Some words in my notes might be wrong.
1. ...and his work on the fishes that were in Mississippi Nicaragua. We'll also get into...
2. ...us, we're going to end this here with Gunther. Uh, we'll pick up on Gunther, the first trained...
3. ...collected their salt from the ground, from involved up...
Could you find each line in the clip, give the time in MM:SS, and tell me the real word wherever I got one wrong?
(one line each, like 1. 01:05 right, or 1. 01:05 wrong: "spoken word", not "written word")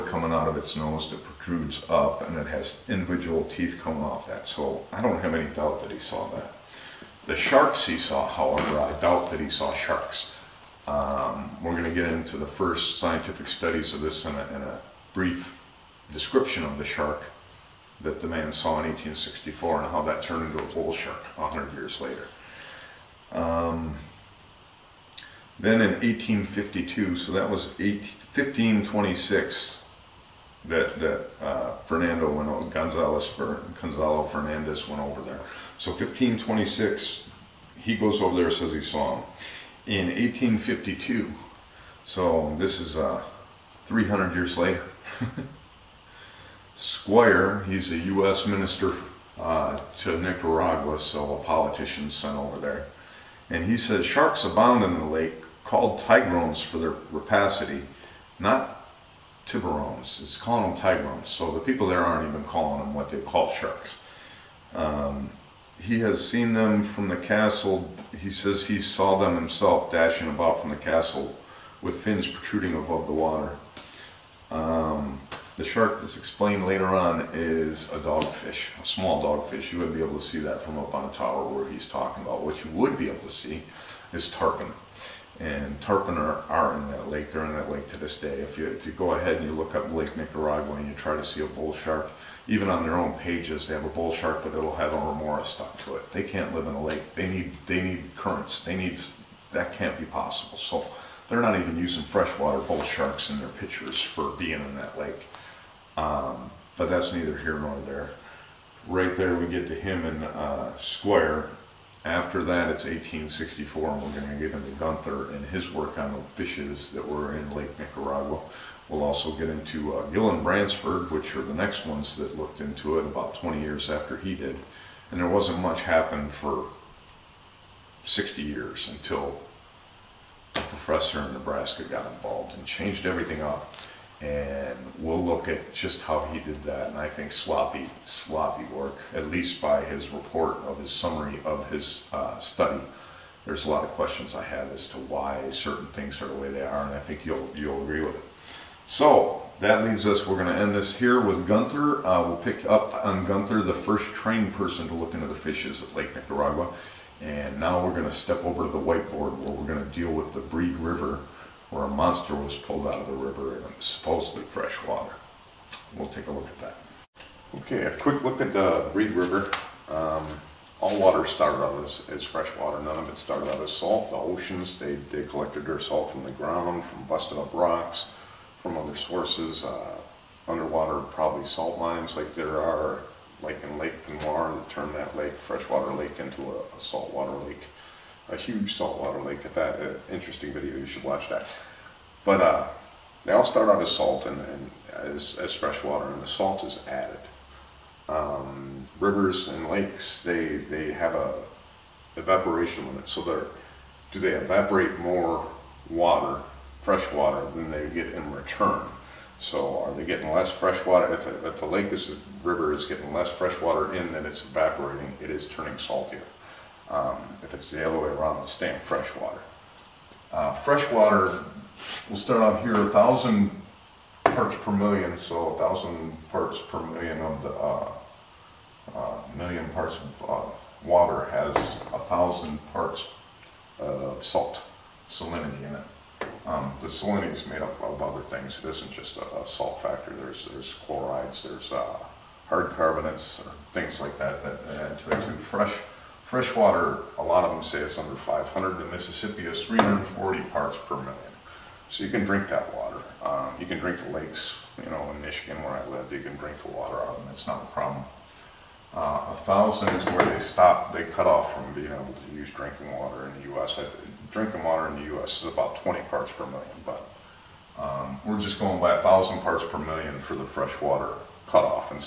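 1. 01:55 wrong: "Lake", not "Mississippi"
2. 02:30 right
3. 02:55 wrong: "busted", not "involved".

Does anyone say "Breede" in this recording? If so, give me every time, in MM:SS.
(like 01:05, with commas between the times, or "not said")
02:40, 02:48.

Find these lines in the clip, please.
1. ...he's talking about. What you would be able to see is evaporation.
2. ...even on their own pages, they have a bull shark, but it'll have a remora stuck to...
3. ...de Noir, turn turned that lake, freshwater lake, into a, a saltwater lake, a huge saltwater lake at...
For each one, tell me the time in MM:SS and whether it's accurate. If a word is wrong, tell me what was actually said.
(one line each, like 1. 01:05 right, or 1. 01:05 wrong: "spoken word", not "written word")
1. 01:21 wrong: "tarpon", not "evaporation"
2. 01:32 right
3. 03:04 right.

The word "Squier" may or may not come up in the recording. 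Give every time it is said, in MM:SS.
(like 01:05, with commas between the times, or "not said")
00:46, 01:50.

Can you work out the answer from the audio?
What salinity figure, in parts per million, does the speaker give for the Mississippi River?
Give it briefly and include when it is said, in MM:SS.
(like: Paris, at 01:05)
340, at 04:09.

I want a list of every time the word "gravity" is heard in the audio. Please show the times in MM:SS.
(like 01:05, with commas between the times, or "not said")
not said.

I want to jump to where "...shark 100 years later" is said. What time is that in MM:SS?
00:20.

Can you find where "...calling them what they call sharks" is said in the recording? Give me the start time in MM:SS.
01:02.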